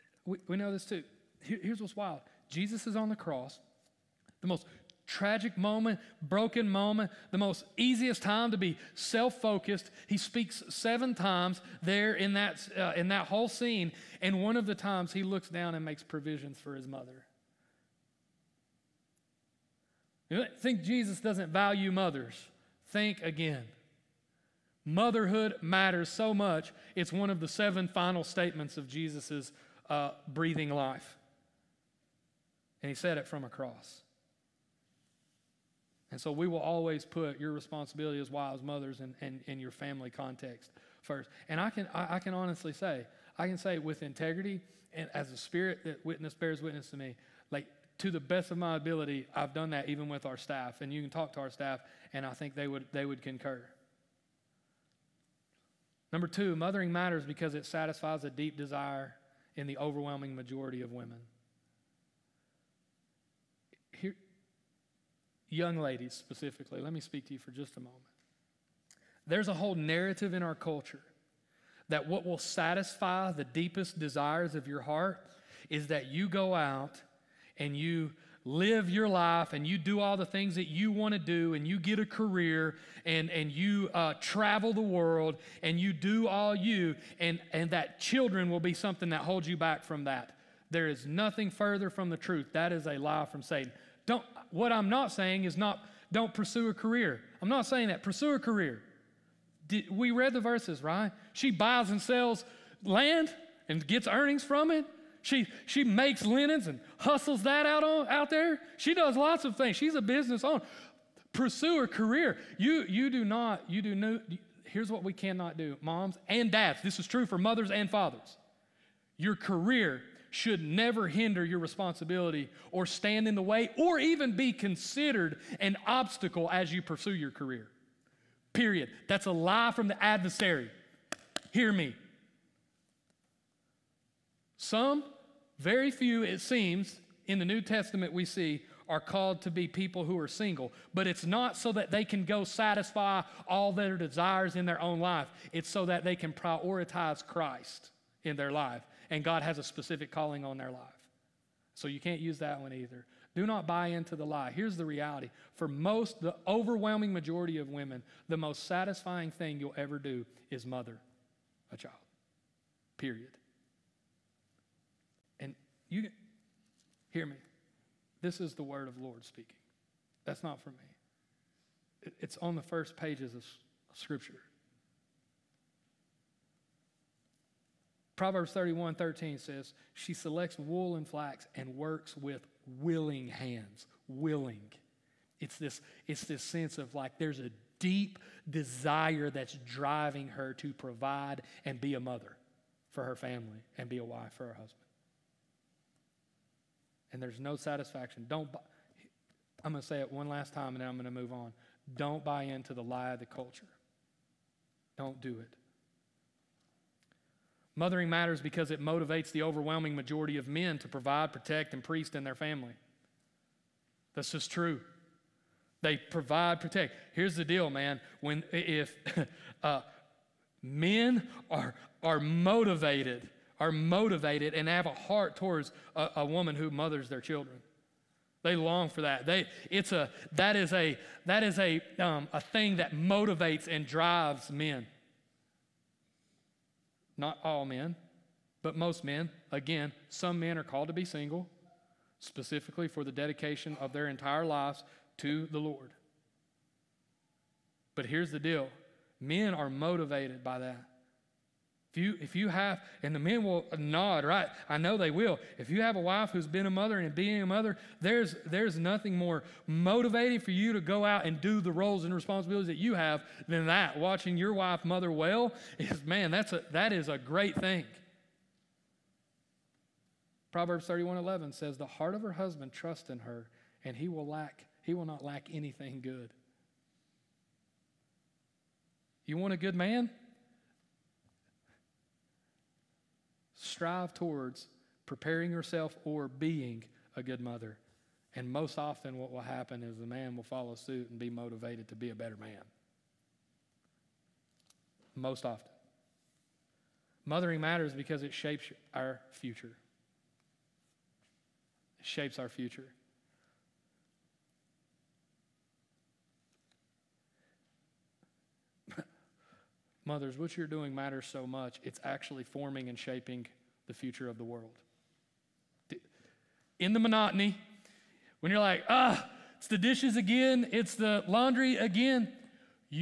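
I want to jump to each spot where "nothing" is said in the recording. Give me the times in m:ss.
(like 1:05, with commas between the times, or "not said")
1:31, 4:18.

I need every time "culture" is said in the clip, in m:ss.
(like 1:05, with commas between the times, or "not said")
1:10, 3:23.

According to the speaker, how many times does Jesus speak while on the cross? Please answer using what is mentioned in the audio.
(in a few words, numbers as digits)
7.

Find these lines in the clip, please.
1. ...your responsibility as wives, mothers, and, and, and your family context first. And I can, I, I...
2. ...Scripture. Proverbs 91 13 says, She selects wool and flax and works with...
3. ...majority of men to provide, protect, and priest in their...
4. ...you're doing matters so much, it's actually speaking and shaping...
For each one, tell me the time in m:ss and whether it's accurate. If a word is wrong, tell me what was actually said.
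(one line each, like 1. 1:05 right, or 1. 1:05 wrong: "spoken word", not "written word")
1. 0:37 right
2. 2:53 wrong: "31", not "91"
3. 3:29 right
4. 5:10 wrong: "forming", not "speaking".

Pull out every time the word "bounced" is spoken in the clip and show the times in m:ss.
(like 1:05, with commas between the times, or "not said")
not said.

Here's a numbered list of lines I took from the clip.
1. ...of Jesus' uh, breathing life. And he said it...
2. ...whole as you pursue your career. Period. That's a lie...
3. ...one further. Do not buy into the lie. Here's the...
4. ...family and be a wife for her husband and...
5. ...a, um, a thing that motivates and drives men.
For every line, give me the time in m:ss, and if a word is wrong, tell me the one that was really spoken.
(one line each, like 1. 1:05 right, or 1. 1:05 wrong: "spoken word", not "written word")
1. 0:28 right
2. 2:05 wrong: "obstacle", not "whole"
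3. 2:32 wrong: "either", not "further"
4. 3:13 right
5. 3:51 right.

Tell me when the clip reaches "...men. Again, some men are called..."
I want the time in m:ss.
3:59.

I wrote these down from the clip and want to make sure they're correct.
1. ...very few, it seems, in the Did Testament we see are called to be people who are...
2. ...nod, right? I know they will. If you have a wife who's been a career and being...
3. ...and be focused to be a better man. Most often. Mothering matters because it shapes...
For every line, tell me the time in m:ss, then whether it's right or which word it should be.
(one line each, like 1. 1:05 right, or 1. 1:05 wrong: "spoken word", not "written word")
1. 2:15 wrong: "New", not "Did"
2. 4:13 wrong: "mother", not "career"
3. 4:51 wrong: "motivated", not "focused".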